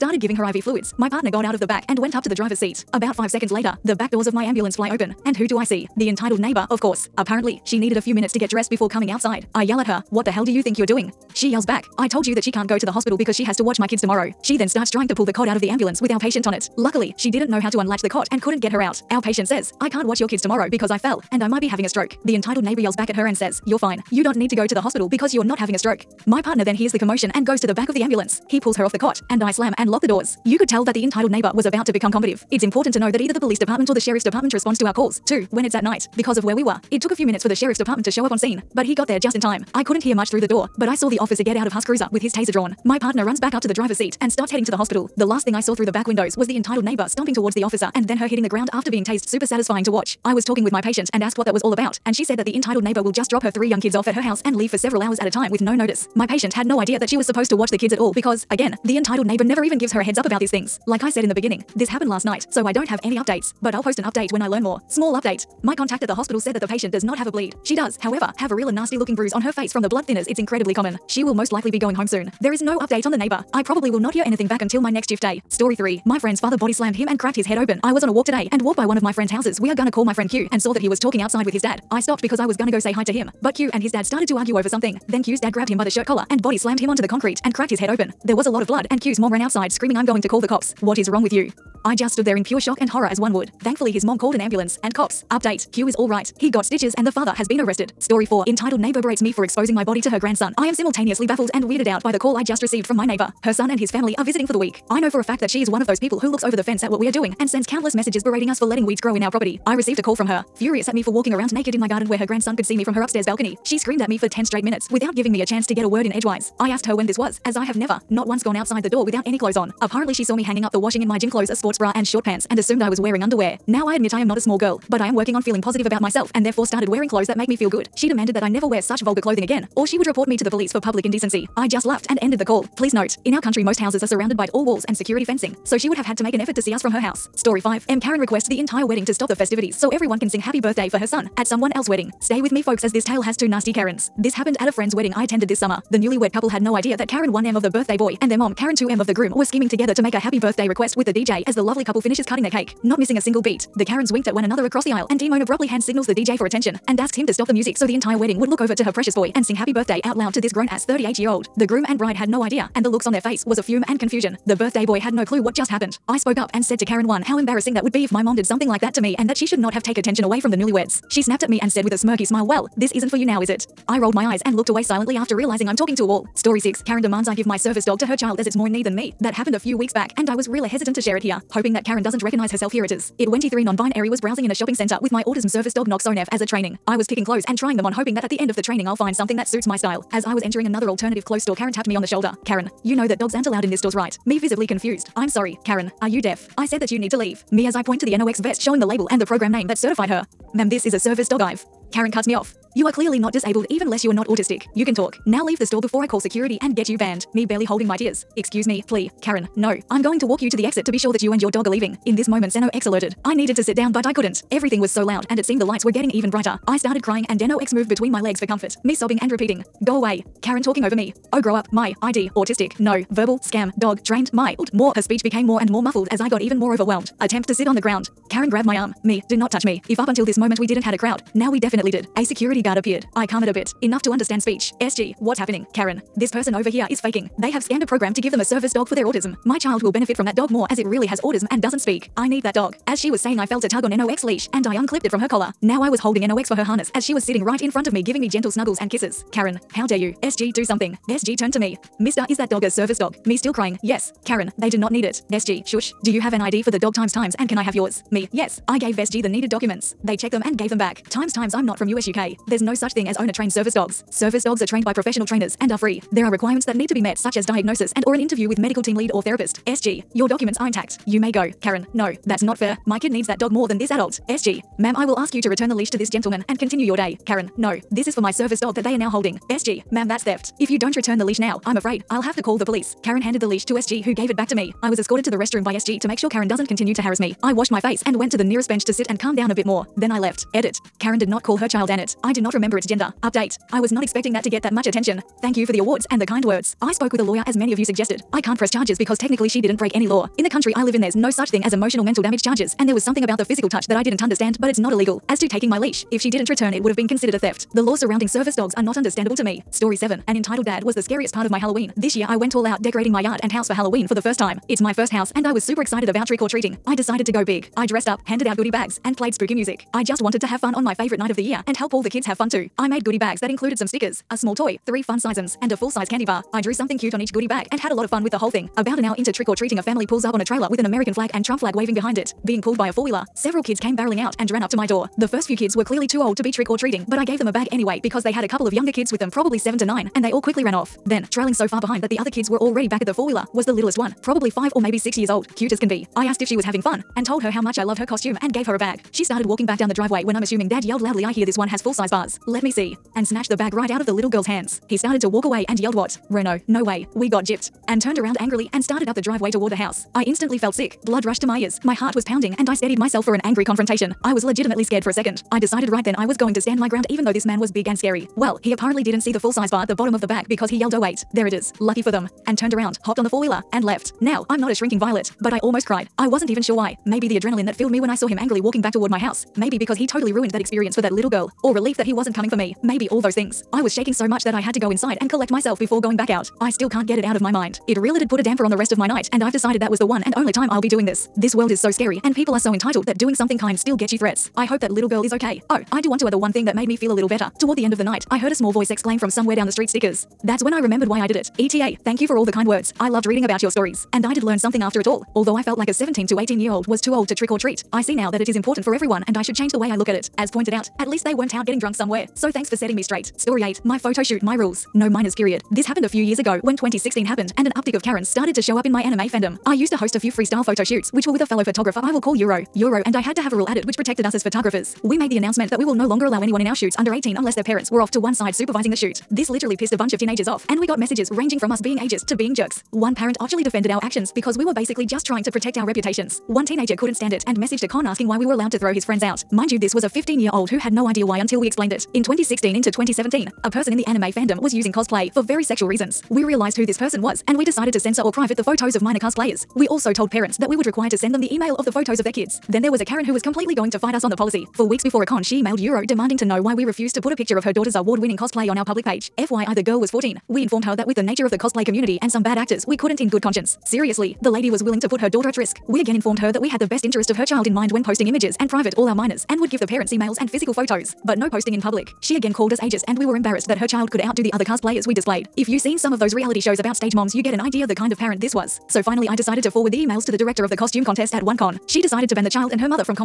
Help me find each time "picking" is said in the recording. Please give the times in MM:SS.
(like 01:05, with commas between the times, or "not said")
03:07.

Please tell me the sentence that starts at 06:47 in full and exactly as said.
I see now that it is important for everyone and I should change the way I look at it.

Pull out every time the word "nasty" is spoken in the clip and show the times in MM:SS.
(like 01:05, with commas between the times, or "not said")
01:08, 02:23.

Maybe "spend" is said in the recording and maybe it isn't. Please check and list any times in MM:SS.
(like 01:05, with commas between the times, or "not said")
not said.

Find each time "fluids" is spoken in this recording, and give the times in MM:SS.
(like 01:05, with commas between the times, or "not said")
00:00.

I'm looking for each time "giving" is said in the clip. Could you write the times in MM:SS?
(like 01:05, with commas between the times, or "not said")
00:00, 01:55, 04:08.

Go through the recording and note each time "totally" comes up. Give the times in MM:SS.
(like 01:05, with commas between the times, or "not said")
06:20.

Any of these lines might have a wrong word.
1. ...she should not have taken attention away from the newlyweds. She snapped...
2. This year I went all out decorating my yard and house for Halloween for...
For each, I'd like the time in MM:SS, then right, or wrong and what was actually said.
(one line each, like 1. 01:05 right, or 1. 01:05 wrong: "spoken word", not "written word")
1. 02:49 right
2. 05:11 right.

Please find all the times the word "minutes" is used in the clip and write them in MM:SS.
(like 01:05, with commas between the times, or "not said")
00:08, 00:37, 01:54.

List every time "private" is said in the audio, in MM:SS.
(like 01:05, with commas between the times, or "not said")
07:28, 07:48.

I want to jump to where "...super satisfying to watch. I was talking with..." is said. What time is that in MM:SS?
00:49.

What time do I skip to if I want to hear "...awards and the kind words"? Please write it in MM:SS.
04:55.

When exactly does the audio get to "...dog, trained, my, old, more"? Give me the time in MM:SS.
03:43.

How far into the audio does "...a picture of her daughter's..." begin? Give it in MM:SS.
07:37.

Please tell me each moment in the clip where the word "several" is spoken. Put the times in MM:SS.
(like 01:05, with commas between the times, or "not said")
00:54, 05:33.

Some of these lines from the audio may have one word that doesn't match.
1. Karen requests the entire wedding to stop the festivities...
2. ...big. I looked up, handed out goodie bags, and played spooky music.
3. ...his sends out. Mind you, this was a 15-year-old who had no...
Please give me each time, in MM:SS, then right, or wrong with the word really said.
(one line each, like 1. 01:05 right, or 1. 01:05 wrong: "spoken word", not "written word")
1. 02:17 right
2. 05:17 wrong: "dressed", not "looked"
3. 07:18 wrong: "friends", not "sends".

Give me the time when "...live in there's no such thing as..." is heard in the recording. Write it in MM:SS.
05:00.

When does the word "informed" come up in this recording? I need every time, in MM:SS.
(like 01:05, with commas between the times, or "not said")
07:40, 07:46.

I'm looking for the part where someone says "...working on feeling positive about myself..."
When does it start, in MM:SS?
02:05.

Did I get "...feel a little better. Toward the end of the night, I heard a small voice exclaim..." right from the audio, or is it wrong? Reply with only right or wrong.
right.